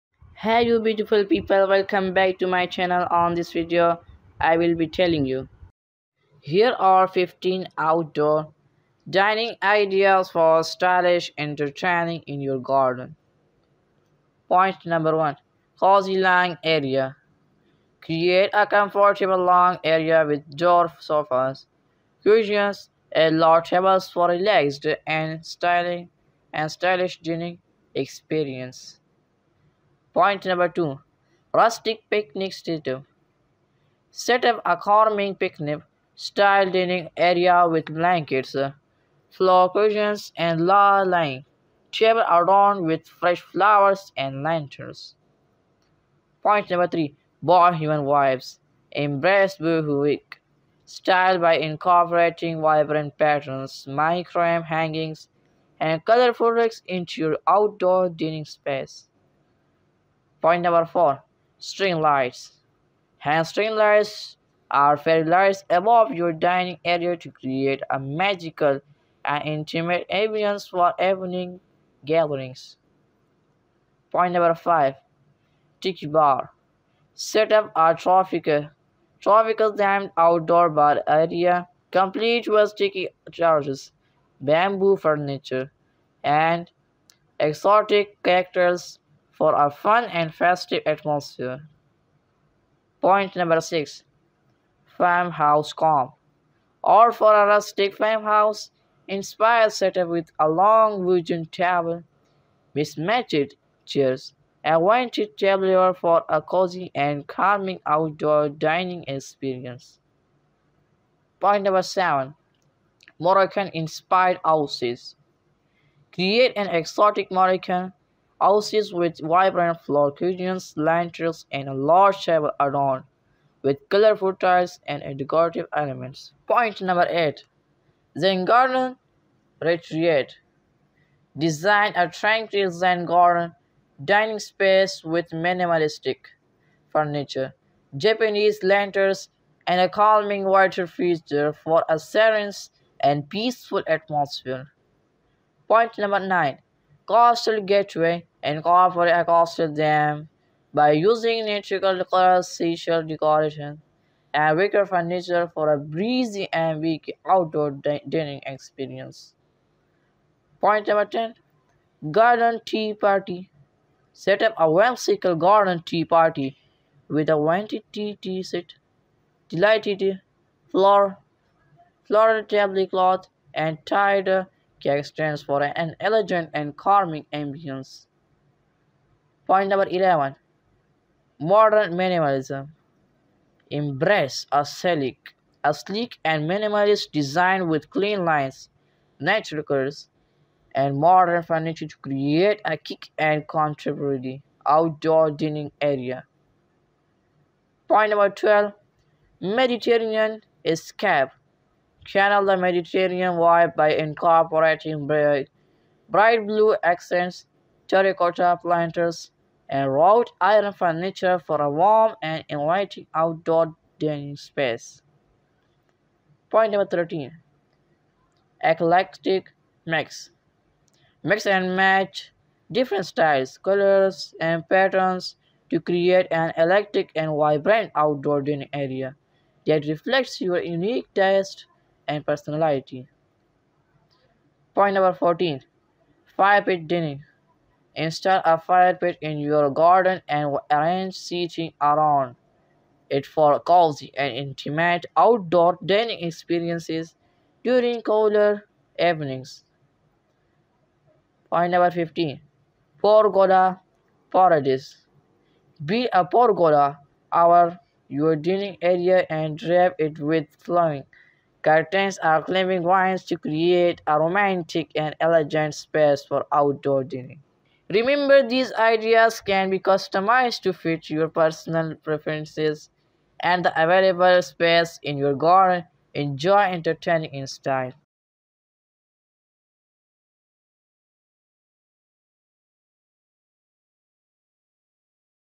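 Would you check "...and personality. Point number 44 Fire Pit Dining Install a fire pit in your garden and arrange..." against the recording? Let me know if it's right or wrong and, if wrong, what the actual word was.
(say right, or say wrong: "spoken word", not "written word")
wrong: "14", not "44".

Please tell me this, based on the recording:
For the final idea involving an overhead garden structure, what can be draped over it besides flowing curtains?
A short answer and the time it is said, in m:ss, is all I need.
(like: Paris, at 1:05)
climbing vines, at 4:22.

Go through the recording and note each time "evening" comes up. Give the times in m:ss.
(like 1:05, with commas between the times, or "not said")
1:10, 4:08.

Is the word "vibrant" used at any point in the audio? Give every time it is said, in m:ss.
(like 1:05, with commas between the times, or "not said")
0:52, 1:59, 3:47.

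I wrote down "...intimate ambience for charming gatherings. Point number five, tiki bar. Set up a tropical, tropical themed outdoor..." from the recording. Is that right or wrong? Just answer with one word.
wrong.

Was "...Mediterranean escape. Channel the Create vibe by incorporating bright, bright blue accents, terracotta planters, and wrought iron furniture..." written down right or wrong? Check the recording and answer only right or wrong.
wrong.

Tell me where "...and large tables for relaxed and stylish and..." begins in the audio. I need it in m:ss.
0:23.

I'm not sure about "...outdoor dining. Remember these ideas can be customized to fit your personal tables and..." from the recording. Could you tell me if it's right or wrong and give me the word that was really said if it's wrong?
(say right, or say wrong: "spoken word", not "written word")
wrong: "preferences", not "tables".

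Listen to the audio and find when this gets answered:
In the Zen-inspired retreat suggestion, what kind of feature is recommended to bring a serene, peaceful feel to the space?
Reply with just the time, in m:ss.
2:19.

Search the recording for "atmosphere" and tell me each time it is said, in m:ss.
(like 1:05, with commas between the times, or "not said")
1:30, 2:23.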